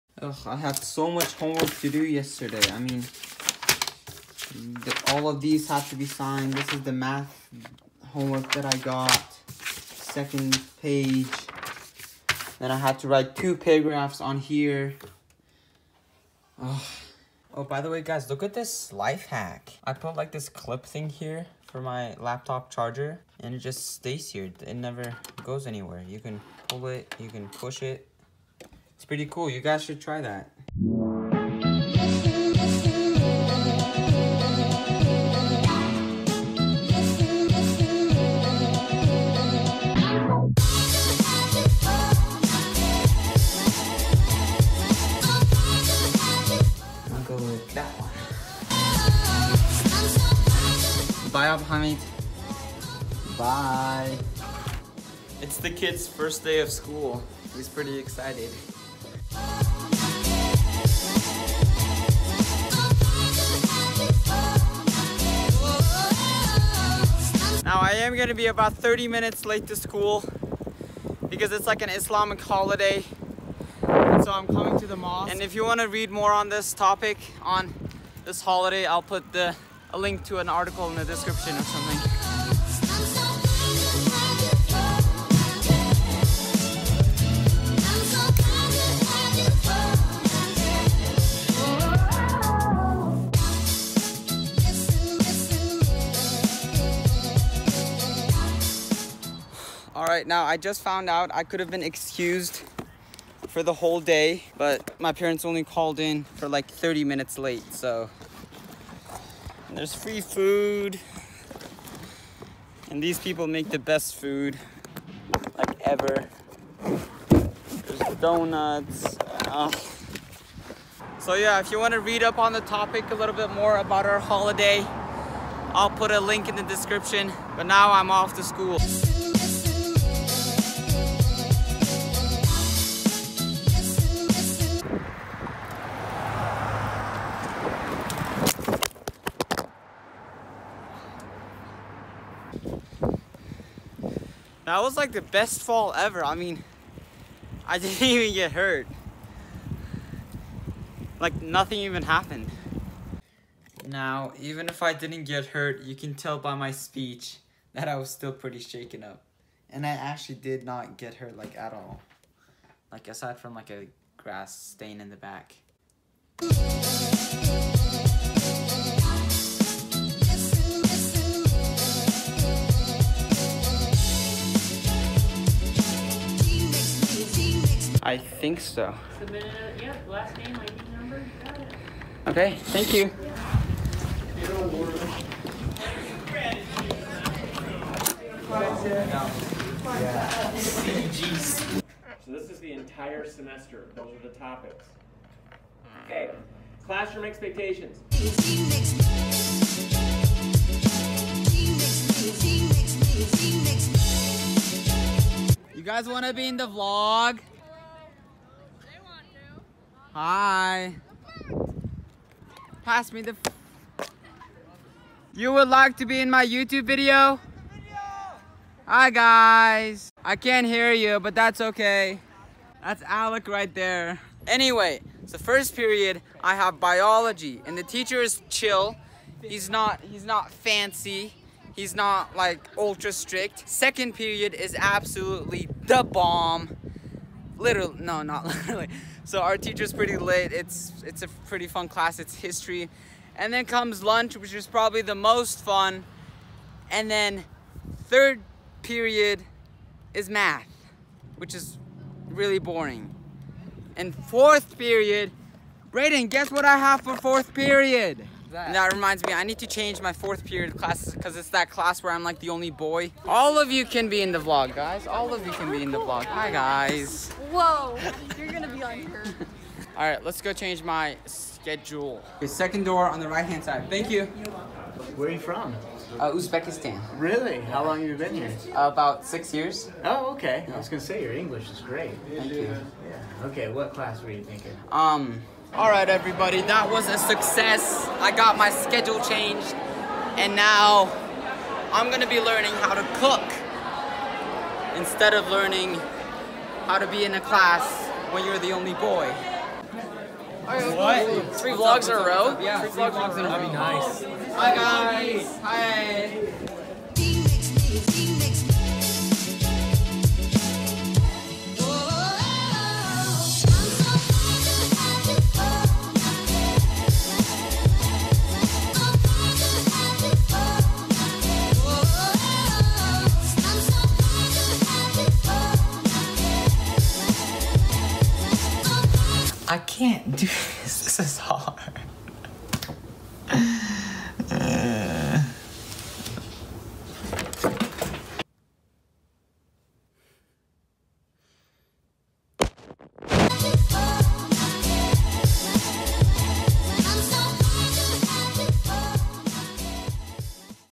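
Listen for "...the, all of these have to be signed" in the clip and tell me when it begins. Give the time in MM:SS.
00:04.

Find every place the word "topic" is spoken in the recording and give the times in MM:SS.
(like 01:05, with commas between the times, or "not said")
01:16, 02:02, 03:14.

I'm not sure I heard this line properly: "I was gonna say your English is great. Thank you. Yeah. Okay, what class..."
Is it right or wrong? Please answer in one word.
right.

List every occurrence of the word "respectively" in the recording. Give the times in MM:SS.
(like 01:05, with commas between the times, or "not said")
not said.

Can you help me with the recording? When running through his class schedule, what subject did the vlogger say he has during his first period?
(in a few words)
Biology.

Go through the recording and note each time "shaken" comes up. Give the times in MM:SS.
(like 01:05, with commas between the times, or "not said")
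02:38.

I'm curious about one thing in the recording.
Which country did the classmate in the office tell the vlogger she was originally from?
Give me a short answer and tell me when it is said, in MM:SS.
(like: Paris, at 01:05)
Uzbekistan, at 04:36.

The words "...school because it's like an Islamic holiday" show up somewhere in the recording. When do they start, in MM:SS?
01:09.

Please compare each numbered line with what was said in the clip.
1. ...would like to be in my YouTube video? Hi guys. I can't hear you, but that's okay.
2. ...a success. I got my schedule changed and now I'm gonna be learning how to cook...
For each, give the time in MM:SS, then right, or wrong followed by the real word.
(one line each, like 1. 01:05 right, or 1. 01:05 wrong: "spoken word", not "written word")
1. 03:35 right
2. 04:47 right.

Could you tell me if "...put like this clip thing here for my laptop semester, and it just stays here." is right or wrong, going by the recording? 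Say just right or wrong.
wrong.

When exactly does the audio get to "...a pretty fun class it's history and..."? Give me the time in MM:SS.
04:01.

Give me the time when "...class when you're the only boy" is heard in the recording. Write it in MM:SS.
04:57.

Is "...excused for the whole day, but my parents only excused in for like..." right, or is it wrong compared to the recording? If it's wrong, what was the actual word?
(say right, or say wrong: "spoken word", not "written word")
wrong: "called", not "excused".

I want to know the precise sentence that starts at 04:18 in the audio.
And that reminds me, I need to change my fourth period classes because it's that class where I'm like the only boy.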